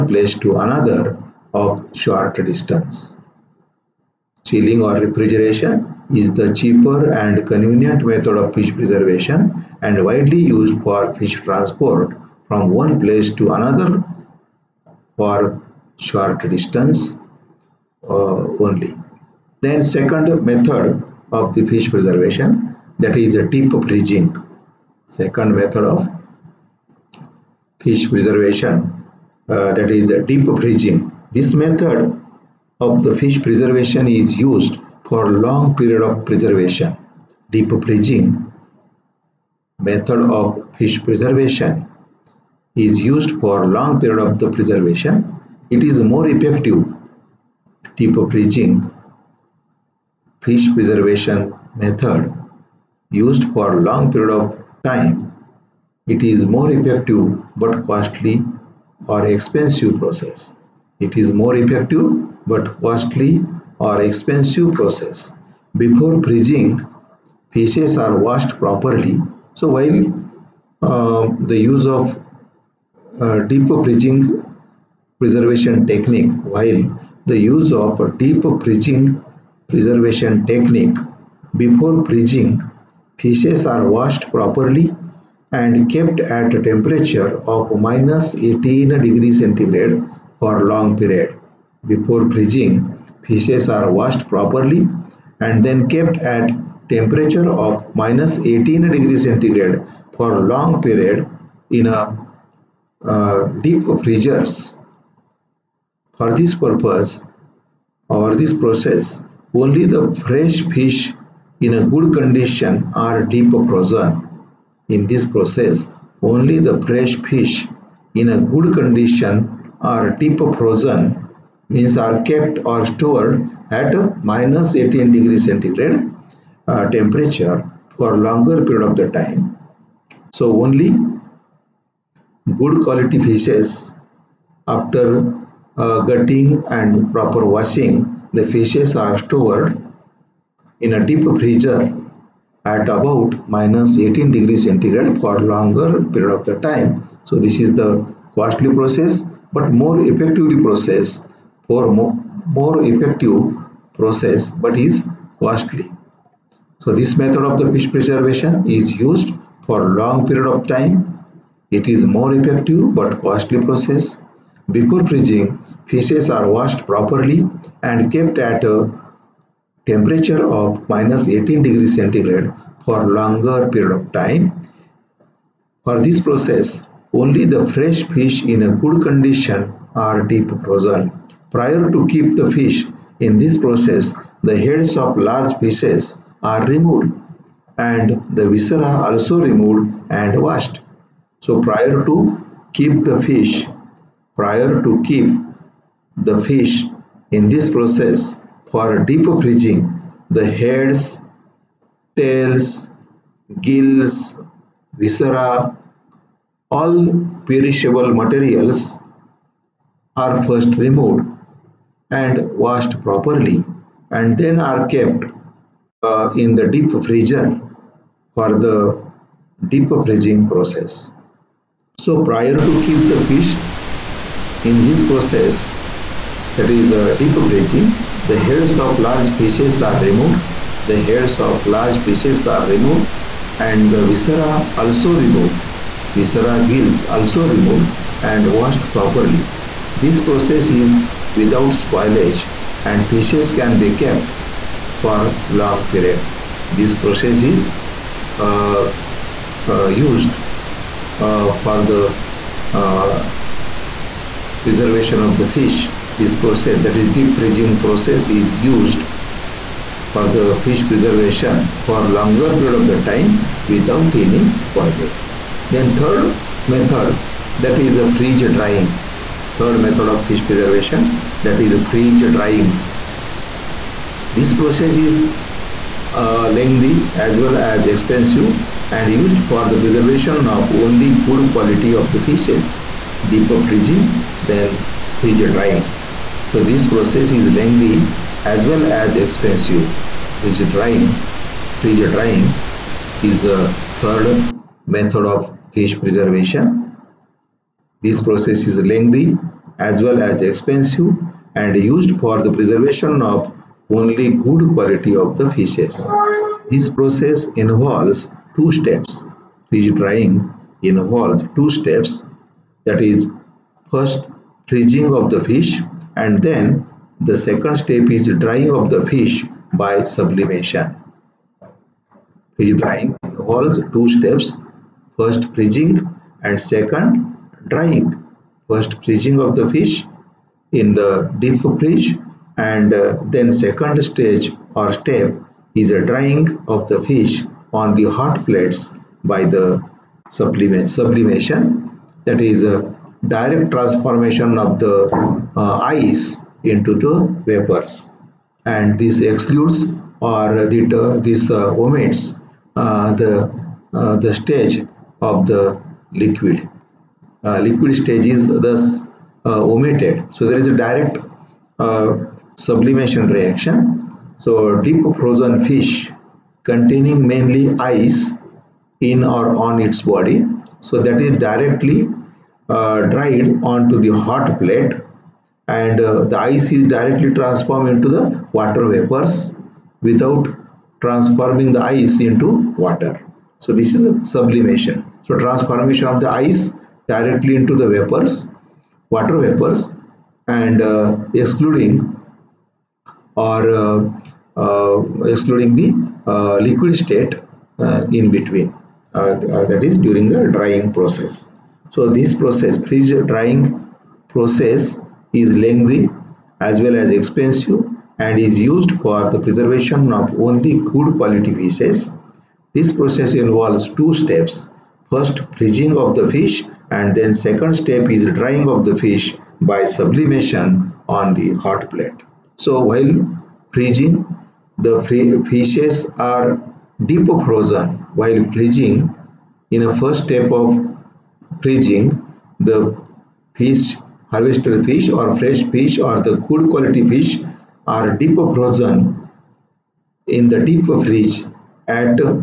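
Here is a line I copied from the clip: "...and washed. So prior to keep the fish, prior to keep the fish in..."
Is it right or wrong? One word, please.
right.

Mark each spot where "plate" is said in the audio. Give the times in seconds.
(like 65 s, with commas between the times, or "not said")
338 s, 374 s, 421 s.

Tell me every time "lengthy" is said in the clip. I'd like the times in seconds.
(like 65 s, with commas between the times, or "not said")
276 s, 287 s, 298 s, 405 s.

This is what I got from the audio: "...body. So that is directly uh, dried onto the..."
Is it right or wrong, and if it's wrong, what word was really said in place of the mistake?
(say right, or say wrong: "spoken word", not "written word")
right.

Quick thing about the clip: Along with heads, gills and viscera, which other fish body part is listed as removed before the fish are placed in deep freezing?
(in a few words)
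Tails.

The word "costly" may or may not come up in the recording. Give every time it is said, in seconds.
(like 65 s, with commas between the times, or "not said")
57 s, 62 s, 148 s, 155 s, 163 s.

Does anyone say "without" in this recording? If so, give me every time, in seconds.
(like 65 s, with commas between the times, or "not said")
241 s, 263 s, 380 s.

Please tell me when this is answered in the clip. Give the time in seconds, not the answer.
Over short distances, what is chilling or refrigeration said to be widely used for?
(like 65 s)
11 s.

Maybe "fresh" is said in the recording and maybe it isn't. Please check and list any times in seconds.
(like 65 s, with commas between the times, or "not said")
110 s, 116 s, 177 s, 435 s.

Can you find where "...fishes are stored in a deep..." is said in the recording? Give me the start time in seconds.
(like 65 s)
138 s.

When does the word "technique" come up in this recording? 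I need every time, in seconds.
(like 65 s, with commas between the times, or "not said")
75 s, 80 s.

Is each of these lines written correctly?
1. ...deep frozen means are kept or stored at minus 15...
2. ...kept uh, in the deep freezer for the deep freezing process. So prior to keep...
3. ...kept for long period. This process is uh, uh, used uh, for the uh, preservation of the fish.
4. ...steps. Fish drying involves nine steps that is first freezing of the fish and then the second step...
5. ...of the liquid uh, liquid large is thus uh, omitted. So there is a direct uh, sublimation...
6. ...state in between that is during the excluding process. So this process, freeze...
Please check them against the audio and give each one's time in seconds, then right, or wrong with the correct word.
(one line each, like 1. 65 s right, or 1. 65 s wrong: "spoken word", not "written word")
1. 120 s wrong: "18", not "15"
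2. 214 s right
3. 244 s right
4. 308 s wrong: "two", not "nine"
5. 355 s wrong: "stage", not "large"
6. 396 s wrong: "drying", not "excluding".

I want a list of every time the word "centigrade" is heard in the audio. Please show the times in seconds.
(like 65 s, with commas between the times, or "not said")
89 s, 99 s, 125 s, 144 s, 171 s.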